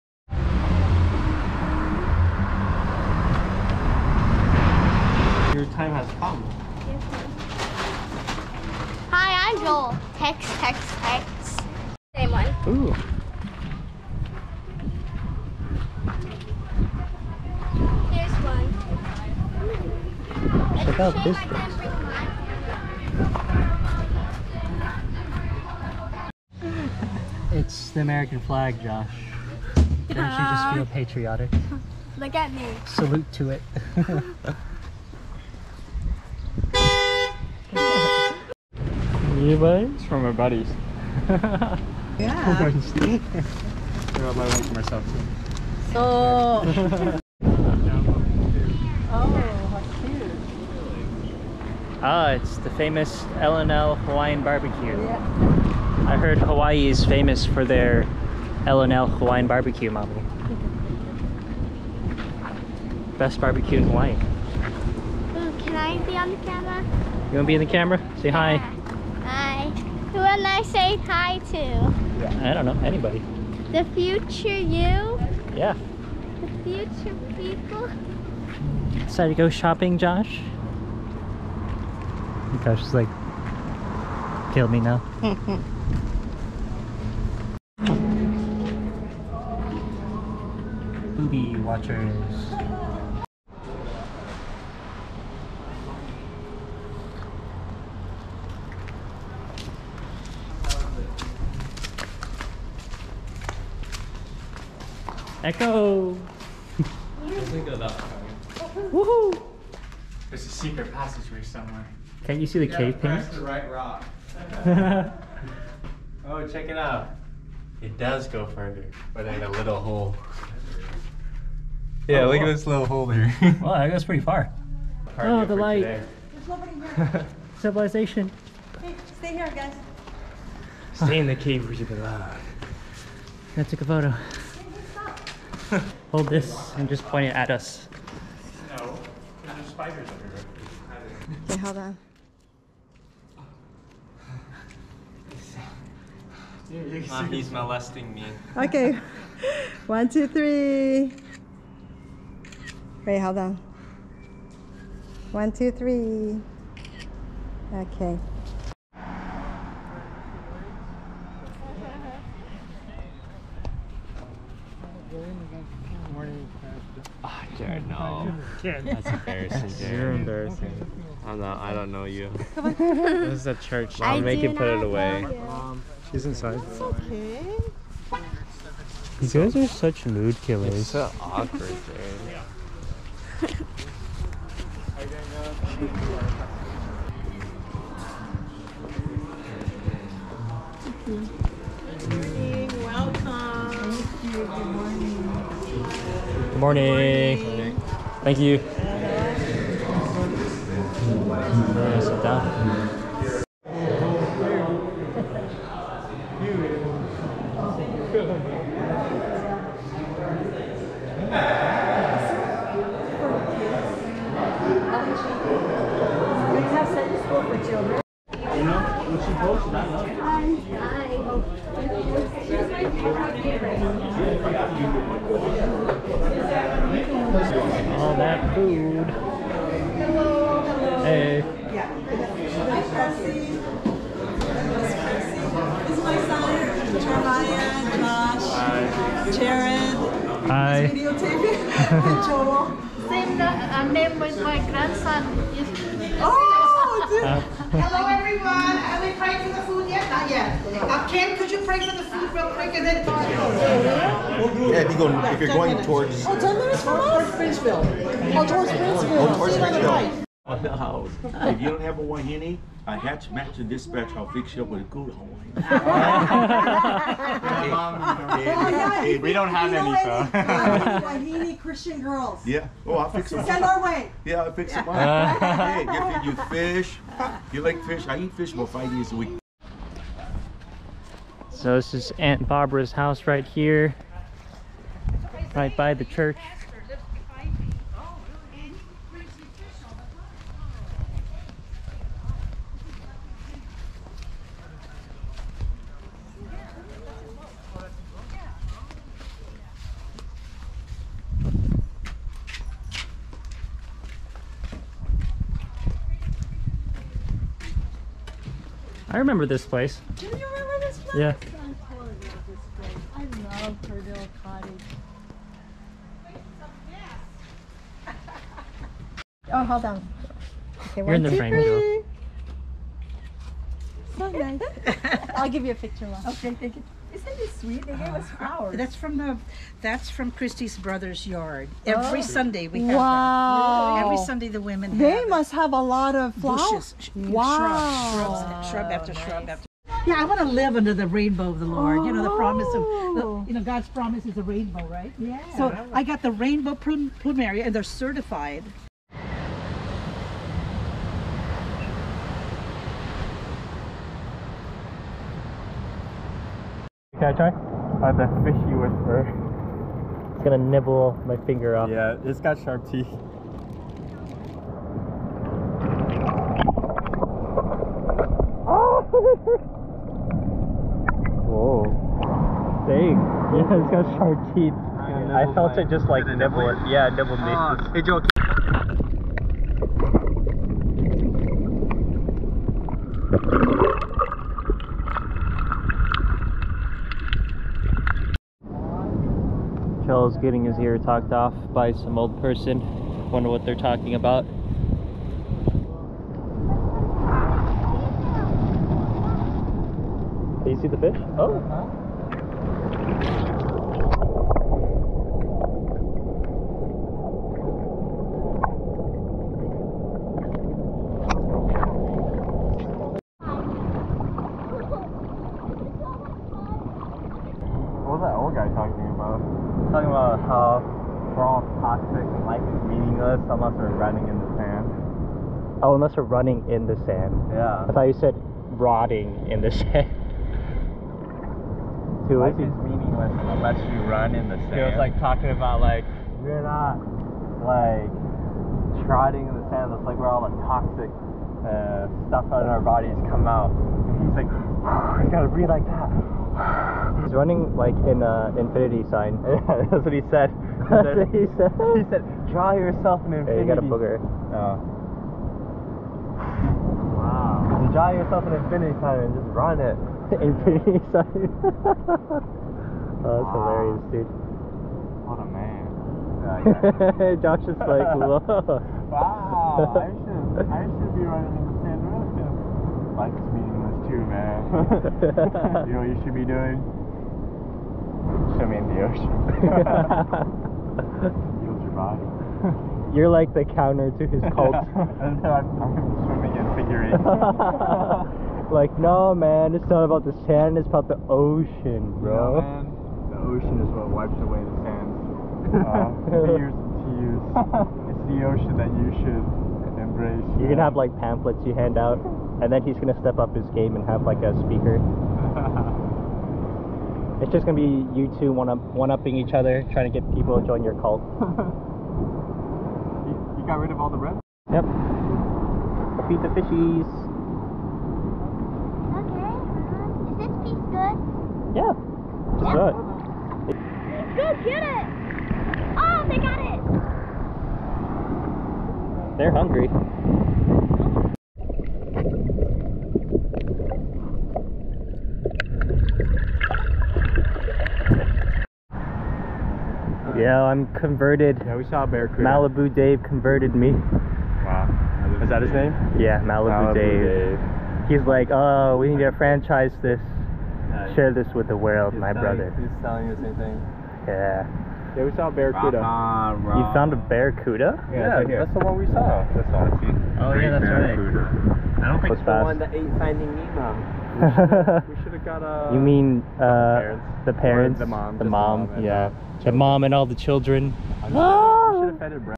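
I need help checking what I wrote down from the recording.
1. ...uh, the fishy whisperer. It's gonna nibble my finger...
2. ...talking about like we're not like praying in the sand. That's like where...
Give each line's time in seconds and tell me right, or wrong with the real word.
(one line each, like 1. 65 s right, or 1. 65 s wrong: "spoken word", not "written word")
1. 358 s right
2. 435 s wrong: "trotting", not "praying".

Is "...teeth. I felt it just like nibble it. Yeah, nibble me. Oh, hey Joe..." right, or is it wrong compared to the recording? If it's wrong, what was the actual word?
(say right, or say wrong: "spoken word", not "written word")
right.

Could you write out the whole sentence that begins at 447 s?
He's running like an infinity sign.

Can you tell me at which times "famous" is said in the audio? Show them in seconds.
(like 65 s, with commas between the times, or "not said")
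52 s, 57 s.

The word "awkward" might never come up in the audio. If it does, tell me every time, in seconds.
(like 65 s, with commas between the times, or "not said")
181 s.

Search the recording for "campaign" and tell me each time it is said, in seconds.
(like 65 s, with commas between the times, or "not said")
not said.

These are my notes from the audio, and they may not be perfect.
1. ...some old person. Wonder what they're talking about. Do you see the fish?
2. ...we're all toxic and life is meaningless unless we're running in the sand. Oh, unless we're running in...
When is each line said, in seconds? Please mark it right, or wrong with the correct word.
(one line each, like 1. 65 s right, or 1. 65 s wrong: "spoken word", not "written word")
1. 391 s right
2. 421 s right.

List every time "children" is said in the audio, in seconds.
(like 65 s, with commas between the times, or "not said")
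217 s, 570 s.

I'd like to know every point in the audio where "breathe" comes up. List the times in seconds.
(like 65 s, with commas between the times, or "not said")
445 s.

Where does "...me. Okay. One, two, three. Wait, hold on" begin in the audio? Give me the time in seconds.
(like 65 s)
148 s.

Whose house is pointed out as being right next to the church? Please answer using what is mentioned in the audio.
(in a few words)
Aunt Barbara's.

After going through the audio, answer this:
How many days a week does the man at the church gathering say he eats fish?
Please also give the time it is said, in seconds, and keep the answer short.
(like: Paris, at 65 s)
5, at 278 s.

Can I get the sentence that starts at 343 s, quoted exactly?
you know God's promise is a rainbow, right?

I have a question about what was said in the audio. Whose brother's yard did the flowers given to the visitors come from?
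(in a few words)
Christie's.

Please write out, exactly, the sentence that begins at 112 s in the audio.
Can't you see the yeah, cave paint?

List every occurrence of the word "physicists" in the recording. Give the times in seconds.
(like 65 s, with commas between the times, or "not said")
not said.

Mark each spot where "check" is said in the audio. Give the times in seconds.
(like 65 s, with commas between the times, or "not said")
20 s, 116 s.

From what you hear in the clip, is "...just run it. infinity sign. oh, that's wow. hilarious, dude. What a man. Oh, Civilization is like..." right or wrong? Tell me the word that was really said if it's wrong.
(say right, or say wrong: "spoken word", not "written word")
wrong: "Josh", not "Civilization".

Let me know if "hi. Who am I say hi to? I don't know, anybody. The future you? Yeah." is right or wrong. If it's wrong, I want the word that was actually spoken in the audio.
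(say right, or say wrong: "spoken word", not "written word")
right.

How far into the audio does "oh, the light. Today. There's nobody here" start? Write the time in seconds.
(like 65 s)
125 s.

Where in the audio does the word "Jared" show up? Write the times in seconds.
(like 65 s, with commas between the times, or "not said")
169 s, 181 s.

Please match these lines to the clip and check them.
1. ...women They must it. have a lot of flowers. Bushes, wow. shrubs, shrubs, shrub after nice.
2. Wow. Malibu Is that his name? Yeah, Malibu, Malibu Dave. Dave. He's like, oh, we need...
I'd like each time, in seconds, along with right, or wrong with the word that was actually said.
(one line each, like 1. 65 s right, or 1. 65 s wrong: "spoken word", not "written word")
1. 334 s right
2. 543 s right.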